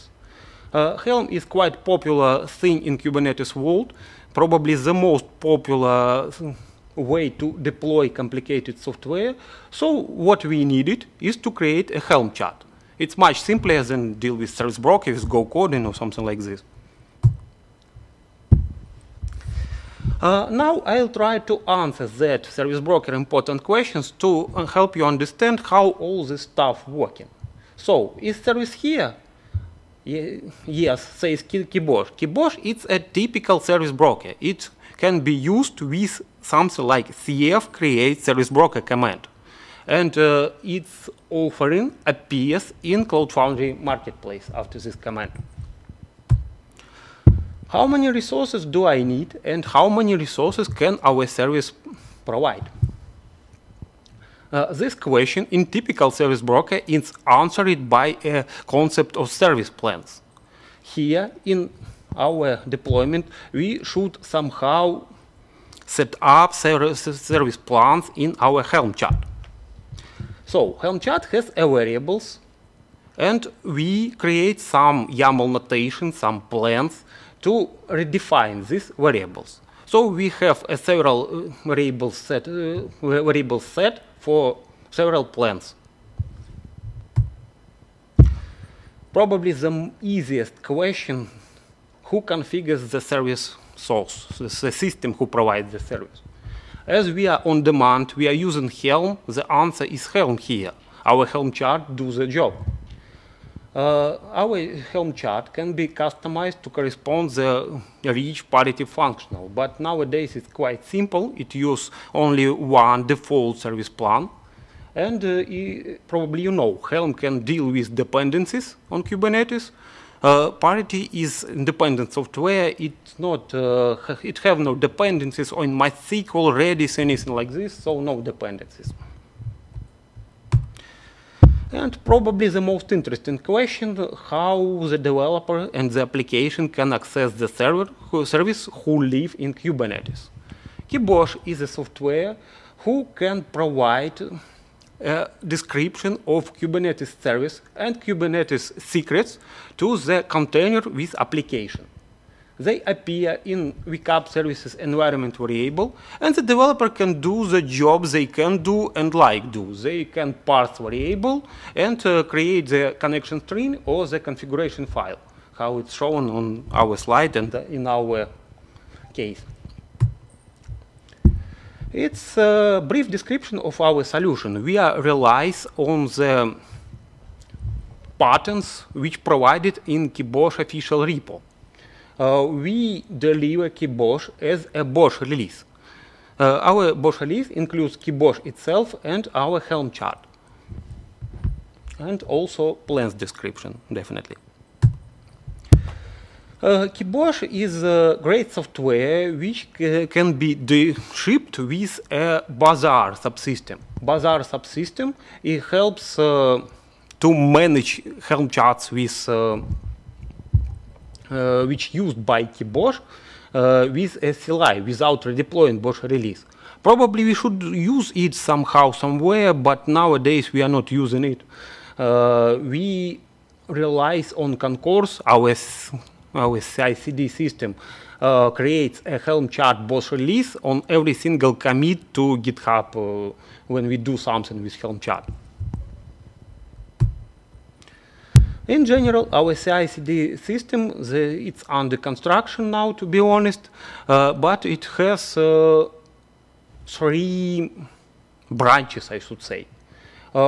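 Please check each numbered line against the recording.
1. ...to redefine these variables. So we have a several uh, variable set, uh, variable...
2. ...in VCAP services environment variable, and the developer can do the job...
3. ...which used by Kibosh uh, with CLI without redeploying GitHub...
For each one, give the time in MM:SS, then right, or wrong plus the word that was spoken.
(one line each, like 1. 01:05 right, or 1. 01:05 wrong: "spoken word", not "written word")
1. 01:17 right
2. 02:33 right
3. 03:31 wrong: "BOSH", not "GitHub".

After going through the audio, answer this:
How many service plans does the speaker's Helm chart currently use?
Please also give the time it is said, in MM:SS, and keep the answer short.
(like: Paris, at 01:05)
1, at 01:52.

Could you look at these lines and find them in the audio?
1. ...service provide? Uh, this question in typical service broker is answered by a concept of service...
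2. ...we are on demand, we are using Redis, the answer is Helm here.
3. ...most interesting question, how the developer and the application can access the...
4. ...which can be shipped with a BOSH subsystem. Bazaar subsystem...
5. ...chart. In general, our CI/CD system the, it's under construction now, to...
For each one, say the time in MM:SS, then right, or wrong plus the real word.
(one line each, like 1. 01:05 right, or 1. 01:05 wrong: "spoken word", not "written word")
1. 00:51 right
2. 01:37 wrong: "Helm", not "Redis"
3. 02:12 right
4. 03:19 wrong: "Bazaar", not "BOSH"
5. 03:54 right.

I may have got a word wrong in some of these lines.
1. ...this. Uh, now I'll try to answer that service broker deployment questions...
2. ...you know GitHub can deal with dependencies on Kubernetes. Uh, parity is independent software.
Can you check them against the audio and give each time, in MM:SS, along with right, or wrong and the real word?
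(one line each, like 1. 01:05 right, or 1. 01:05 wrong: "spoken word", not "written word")
1. 00:16 wrong: "important", not "deployment"
2. 01:56 wrong: "Helm", not "GitHub".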